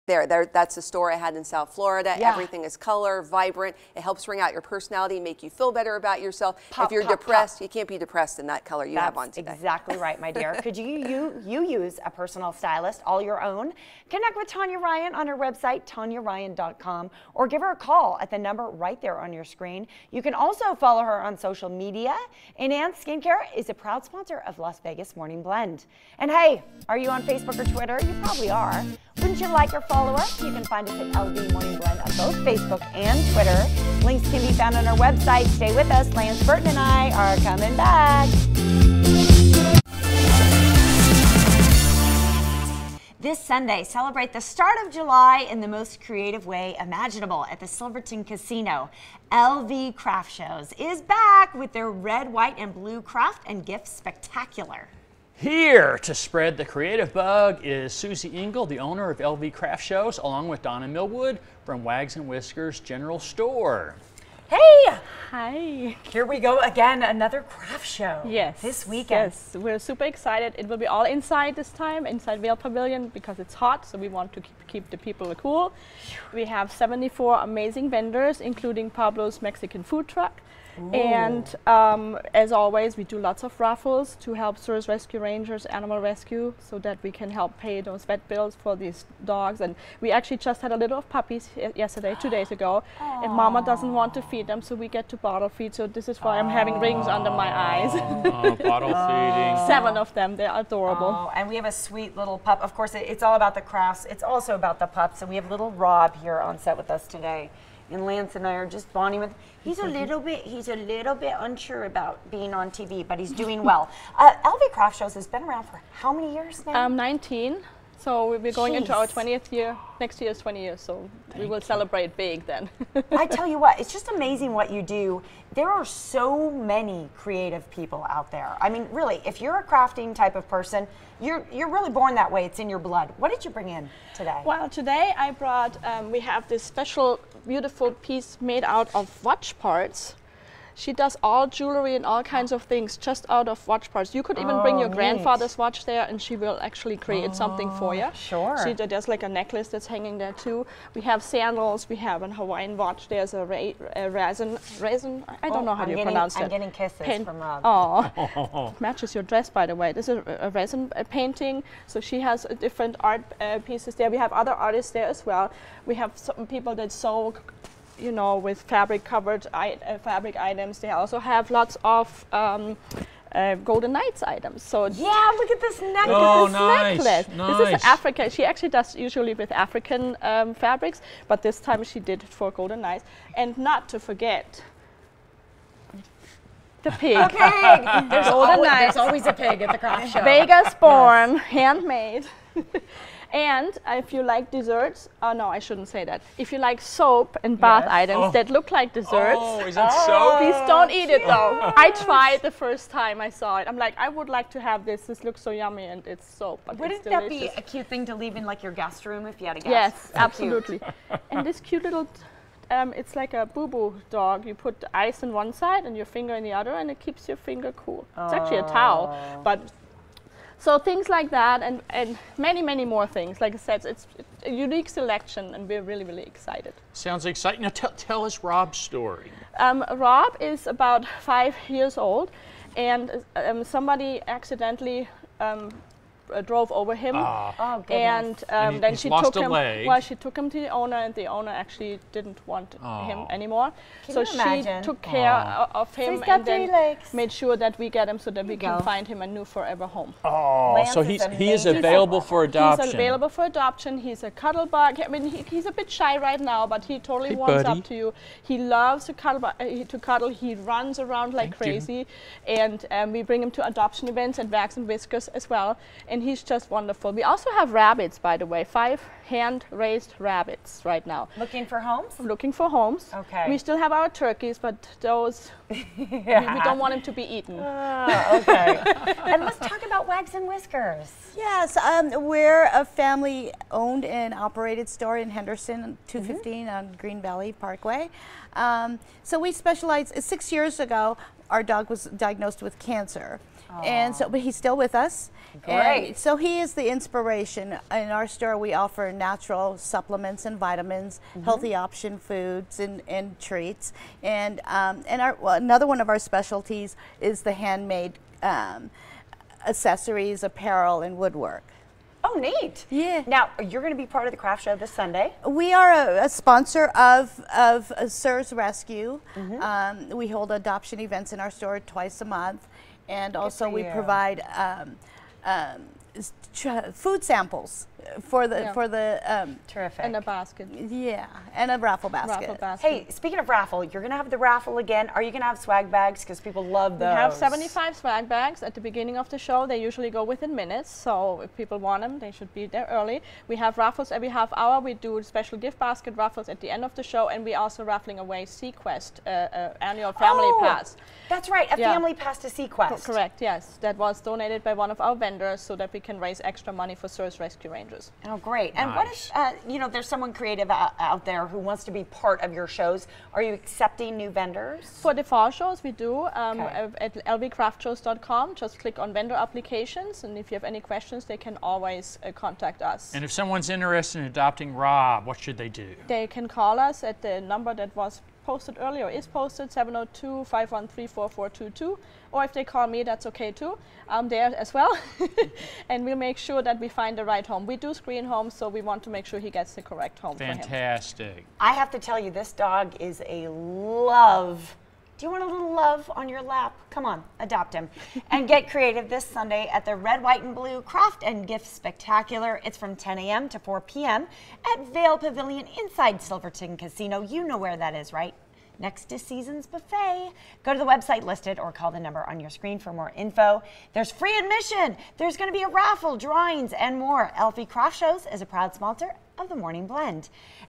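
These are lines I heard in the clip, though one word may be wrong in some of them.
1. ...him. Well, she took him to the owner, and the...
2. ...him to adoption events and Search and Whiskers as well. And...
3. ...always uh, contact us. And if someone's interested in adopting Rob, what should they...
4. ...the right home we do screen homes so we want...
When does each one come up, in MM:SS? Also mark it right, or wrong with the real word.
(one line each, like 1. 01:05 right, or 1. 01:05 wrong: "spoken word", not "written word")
1. 03:59 right
2. 04:23 wrong: "Wags", not "Search"
3. 06:11 right
4. 06:27 right.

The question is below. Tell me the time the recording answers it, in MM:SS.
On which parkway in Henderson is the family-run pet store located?
04:47.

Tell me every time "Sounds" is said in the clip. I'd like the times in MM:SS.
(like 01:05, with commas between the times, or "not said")
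03:46.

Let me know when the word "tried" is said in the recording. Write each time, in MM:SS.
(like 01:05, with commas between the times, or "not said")
03:21.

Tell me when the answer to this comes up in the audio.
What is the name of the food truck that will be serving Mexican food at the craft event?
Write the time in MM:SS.
01:18.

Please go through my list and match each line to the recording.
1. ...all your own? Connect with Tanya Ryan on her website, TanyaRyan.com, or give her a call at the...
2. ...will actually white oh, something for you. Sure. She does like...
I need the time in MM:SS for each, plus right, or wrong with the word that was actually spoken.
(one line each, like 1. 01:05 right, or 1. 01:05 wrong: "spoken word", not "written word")
1. 00:13 right
2. 02:26 wrong: "create", not "white".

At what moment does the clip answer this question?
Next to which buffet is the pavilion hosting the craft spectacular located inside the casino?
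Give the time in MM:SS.
06:49.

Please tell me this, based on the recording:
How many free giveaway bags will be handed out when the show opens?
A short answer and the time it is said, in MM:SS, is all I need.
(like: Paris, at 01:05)
75, at 05:37.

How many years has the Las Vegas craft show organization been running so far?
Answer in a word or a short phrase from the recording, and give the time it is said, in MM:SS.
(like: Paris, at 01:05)
19, at 01:56.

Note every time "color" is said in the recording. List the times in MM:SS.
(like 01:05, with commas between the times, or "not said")
00:02, 00:08.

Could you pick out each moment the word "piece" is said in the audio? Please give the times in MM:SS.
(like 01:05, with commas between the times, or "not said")
02:17, 02:43.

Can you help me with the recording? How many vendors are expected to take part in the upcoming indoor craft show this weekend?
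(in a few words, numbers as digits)
74.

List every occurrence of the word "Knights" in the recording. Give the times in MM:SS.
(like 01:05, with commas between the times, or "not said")
02:53, 03:02.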